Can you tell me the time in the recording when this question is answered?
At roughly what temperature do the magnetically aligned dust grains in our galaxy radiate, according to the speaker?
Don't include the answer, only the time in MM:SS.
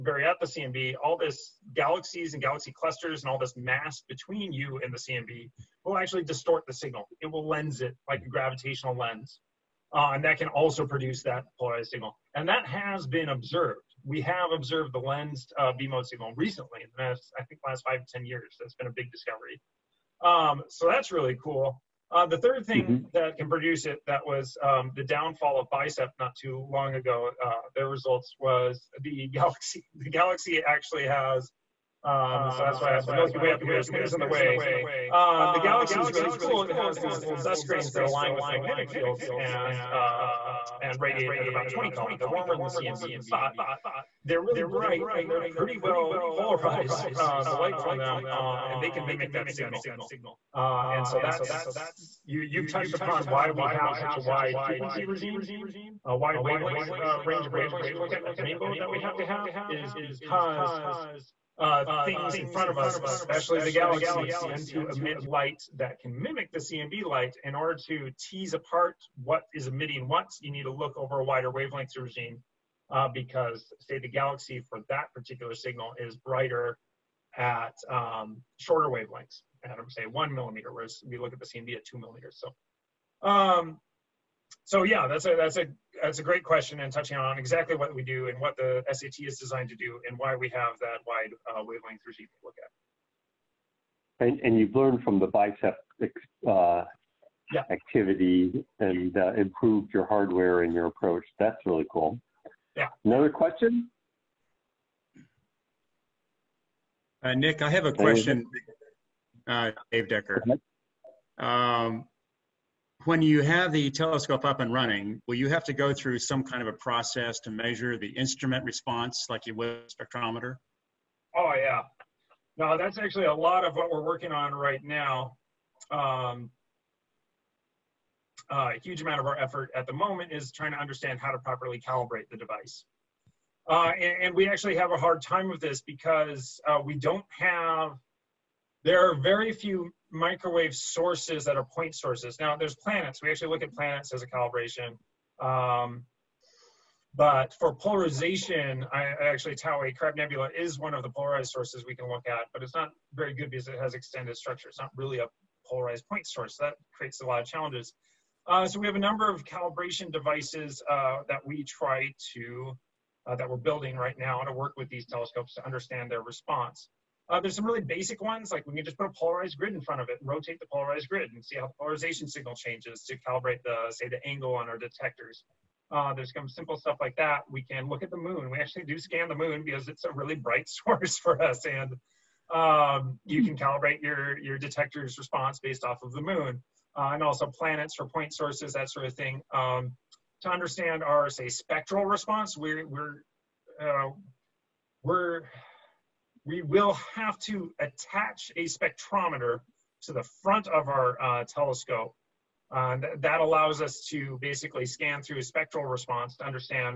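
00:41.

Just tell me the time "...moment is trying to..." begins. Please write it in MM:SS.
02:09.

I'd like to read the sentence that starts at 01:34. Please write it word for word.
And, and you've learned from the BICEP uh, yeah.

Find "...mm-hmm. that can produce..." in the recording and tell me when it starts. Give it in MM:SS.
00:22.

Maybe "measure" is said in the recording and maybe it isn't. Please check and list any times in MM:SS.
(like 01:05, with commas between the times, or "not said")
01:57.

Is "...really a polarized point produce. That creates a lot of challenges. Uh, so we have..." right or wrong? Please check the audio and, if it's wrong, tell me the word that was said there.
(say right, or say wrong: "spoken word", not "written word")
wrong: "source", not "produce".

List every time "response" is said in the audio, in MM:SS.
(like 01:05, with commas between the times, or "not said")
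01:58, 02:46, 03:05, 03:12, 03:25.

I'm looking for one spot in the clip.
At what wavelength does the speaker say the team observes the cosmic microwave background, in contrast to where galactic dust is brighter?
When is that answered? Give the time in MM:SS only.
01:21.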